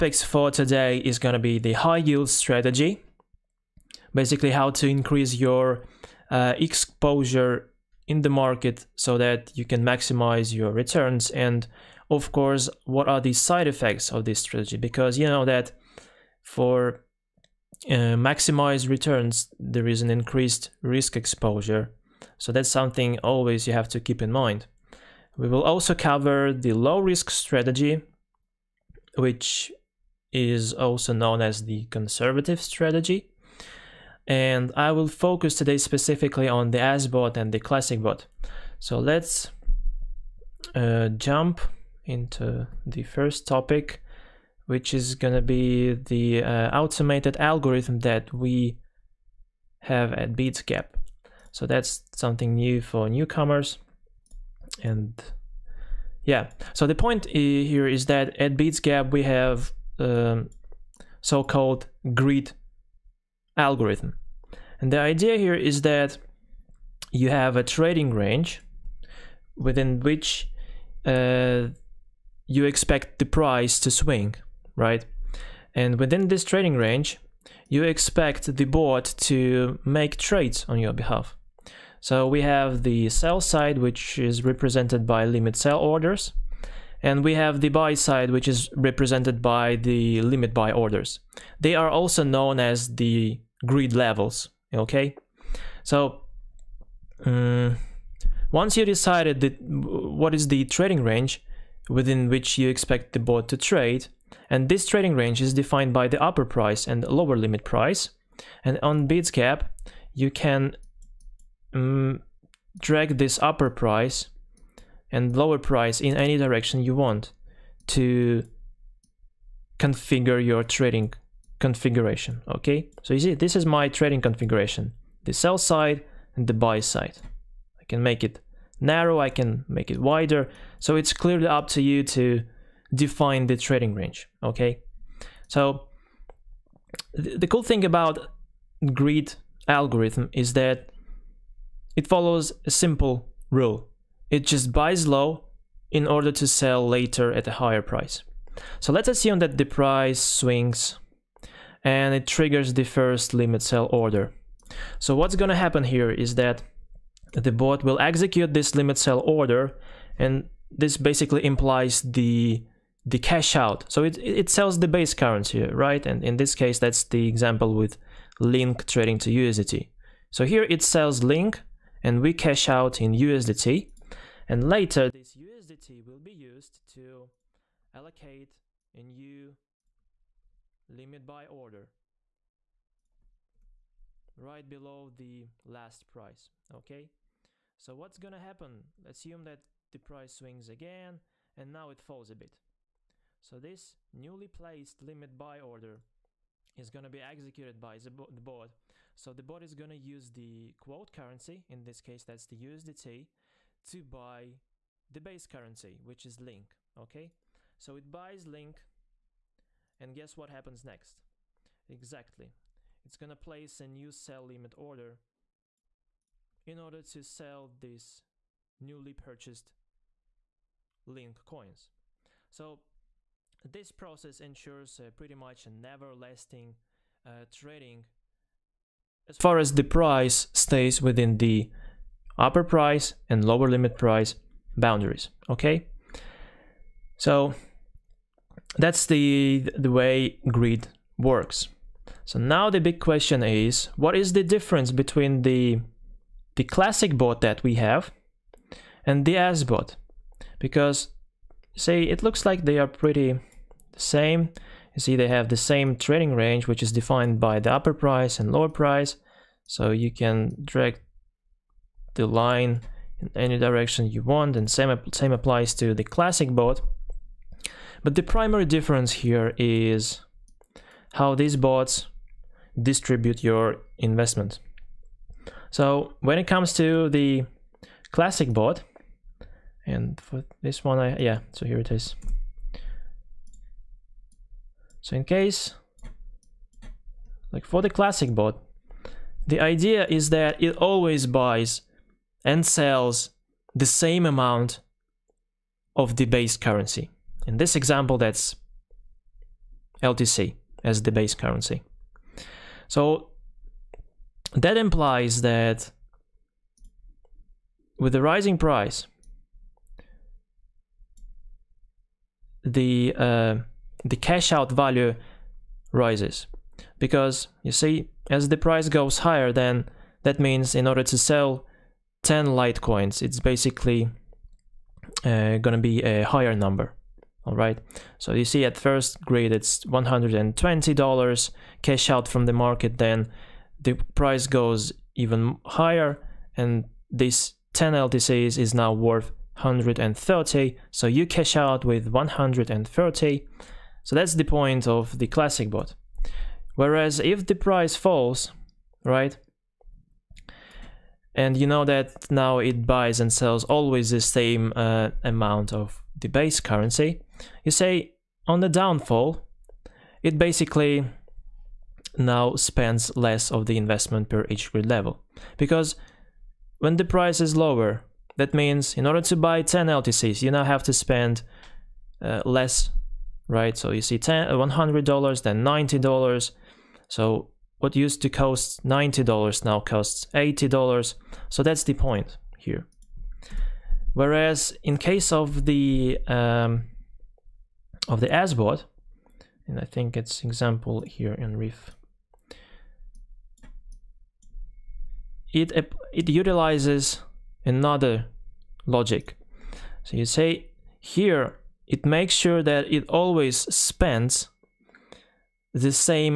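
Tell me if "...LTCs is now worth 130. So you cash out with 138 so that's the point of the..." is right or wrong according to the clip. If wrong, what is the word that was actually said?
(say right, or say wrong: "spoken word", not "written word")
wrong: "130", not "138".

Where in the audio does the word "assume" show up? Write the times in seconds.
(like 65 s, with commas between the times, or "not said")
149 s, 189 s.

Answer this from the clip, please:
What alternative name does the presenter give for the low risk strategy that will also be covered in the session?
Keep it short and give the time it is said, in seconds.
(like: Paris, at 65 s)
Conservative strategy, at 31 s.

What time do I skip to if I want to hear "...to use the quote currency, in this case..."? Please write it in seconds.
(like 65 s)
199 s.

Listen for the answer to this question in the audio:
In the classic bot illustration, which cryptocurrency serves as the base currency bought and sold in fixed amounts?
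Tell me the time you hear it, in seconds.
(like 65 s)
300 s.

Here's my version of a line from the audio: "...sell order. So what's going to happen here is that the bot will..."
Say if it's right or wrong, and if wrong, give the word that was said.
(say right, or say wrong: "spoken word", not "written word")
right.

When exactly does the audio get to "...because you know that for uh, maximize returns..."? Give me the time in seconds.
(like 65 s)
14 s.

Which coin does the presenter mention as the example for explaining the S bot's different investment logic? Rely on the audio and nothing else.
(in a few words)
Reef.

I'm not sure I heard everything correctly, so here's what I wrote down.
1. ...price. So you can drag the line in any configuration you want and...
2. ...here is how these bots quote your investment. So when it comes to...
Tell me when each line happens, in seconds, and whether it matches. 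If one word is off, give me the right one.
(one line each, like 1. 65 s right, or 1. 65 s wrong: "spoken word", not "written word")
1. 258 s wrong: "direction", not "configuration"
2. 269 s wrong: "distribute", not "quote".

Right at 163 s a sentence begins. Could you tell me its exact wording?
So it, it sells the base currency, right?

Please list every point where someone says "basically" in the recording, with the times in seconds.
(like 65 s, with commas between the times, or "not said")
4 s, 160 s, 323 s, 360 s.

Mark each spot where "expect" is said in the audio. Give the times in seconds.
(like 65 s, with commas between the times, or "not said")
72 s, 77 s, 102 s.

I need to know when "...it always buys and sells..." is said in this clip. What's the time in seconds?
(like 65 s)
290 s.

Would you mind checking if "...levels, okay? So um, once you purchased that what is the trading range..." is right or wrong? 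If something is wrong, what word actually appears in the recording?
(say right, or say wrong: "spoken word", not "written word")
wrong: "decided", not "purchased".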